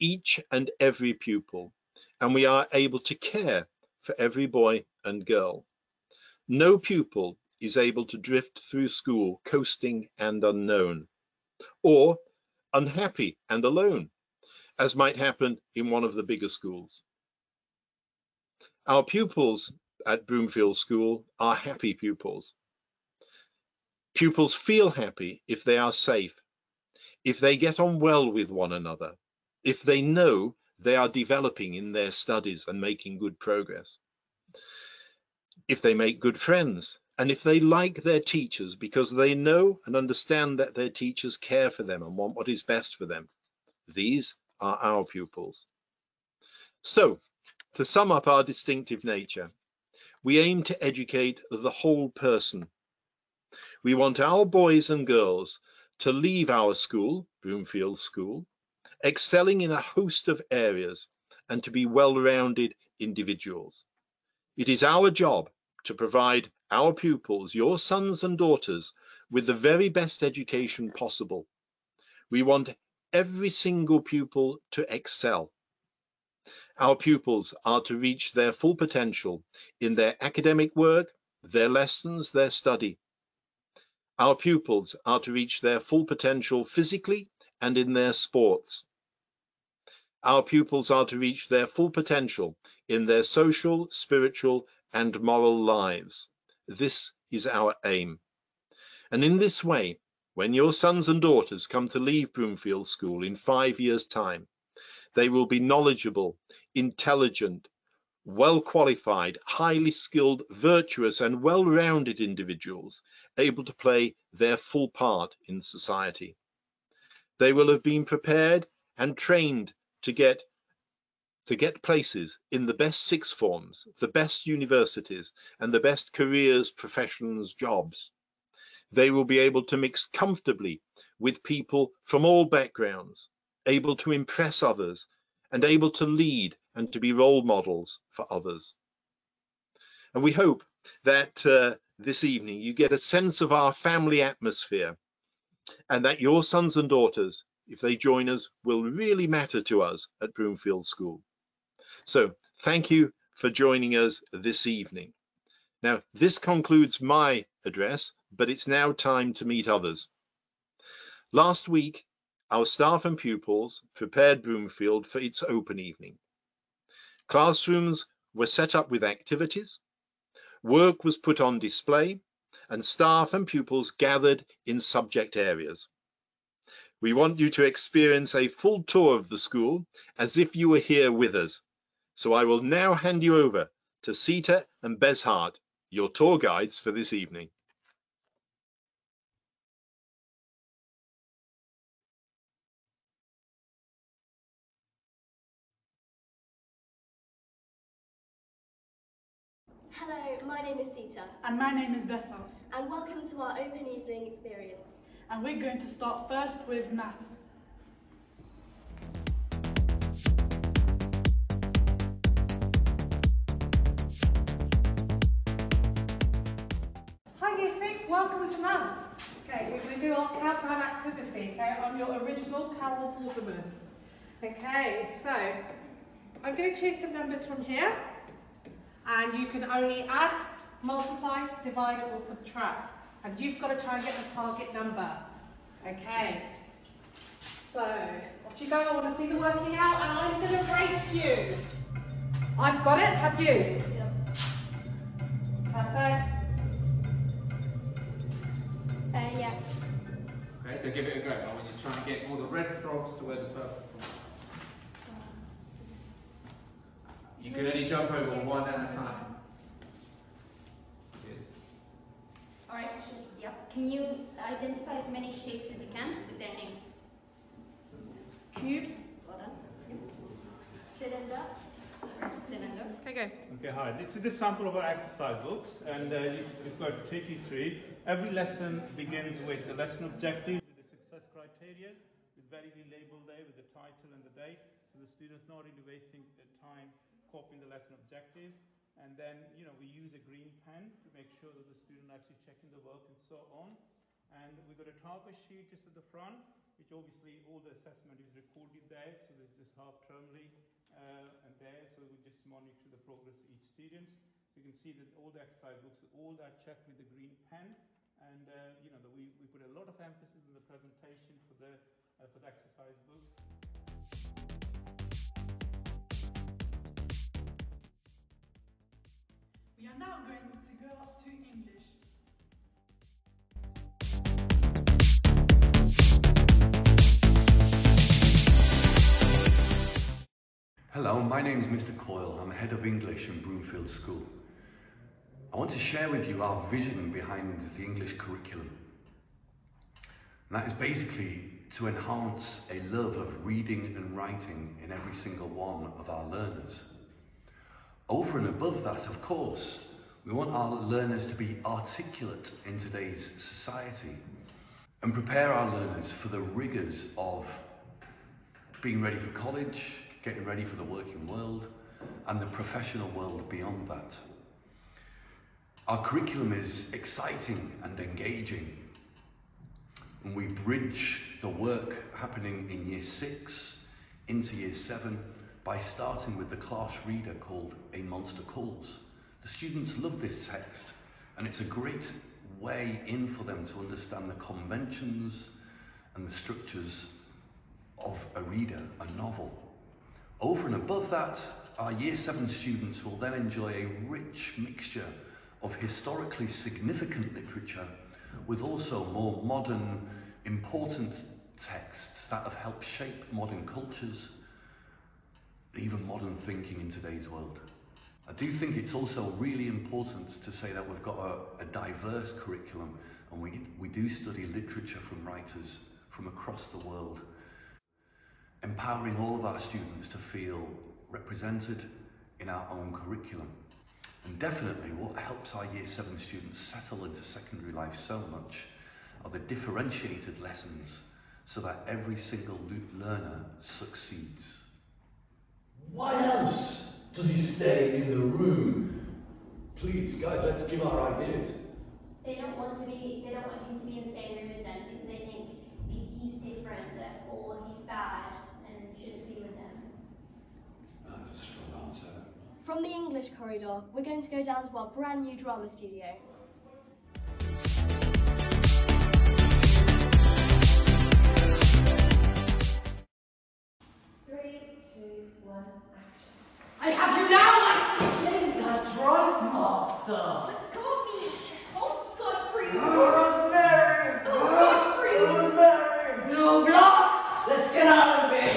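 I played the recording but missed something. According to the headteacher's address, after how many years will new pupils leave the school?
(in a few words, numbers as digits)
5 years.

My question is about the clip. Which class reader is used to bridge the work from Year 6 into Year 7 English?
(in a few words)
A Monster Calls.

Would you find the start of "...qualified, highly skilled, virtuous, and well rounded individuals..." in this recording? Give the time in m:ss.
1:48.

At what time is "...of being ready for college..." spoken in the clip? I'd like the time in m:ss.
5:57.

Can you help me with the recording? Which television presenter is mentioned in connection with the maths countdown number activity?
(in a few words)
Carol Vorderman.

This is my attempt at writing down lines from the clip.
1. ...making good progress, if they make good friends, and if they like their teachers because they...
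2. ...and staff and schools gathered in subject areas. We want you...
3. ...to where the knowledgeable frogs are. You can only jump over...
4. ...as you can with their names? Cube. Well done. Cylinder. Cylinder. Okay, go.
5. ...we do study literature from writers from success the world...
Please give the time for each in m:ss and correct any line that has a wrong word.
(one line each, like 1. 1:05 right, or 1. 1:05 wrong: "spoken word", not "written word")
1. 0:32 right
2. 2:52 wrong: "pupils", not "schools"
3. 4:13 wrong: "purple", not "knowledgeable"
4. 4:25 right
5. 6:53 wrong: "across", not "success".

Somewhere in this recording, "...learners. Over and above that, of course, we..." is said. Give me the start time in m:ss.
5:46.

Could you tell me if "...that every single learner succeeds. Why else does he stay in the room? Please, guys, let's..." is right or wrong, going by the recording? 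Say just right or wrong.
right.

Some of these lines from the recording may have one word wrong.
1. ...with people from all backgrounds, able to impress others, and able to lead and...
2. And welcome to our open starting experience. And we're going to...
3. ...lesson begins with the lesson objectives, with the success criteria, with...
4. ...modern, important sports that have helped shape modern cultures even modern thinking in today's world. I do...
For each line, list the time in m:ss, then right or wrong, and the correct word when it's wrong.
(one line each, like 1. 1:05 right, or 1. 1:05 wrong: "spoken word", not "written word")
1. 2:11 right
2. 3:22 wrong: "evening", not "starting"
3. 4:38 right
4. 6:39 wrong: "texts", not "sports".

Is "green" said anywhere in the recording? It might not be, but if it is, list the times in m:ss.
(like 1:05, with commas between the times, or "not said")
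4:50, 5:07.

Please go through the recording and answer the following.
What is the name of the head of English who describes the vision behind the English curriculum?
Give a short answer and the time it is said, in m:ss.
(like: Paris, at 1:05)
Mr. Coyle, at 5:31.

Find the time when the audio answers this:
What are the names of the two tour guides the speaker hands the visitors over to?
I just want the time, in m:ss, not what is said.
3:04.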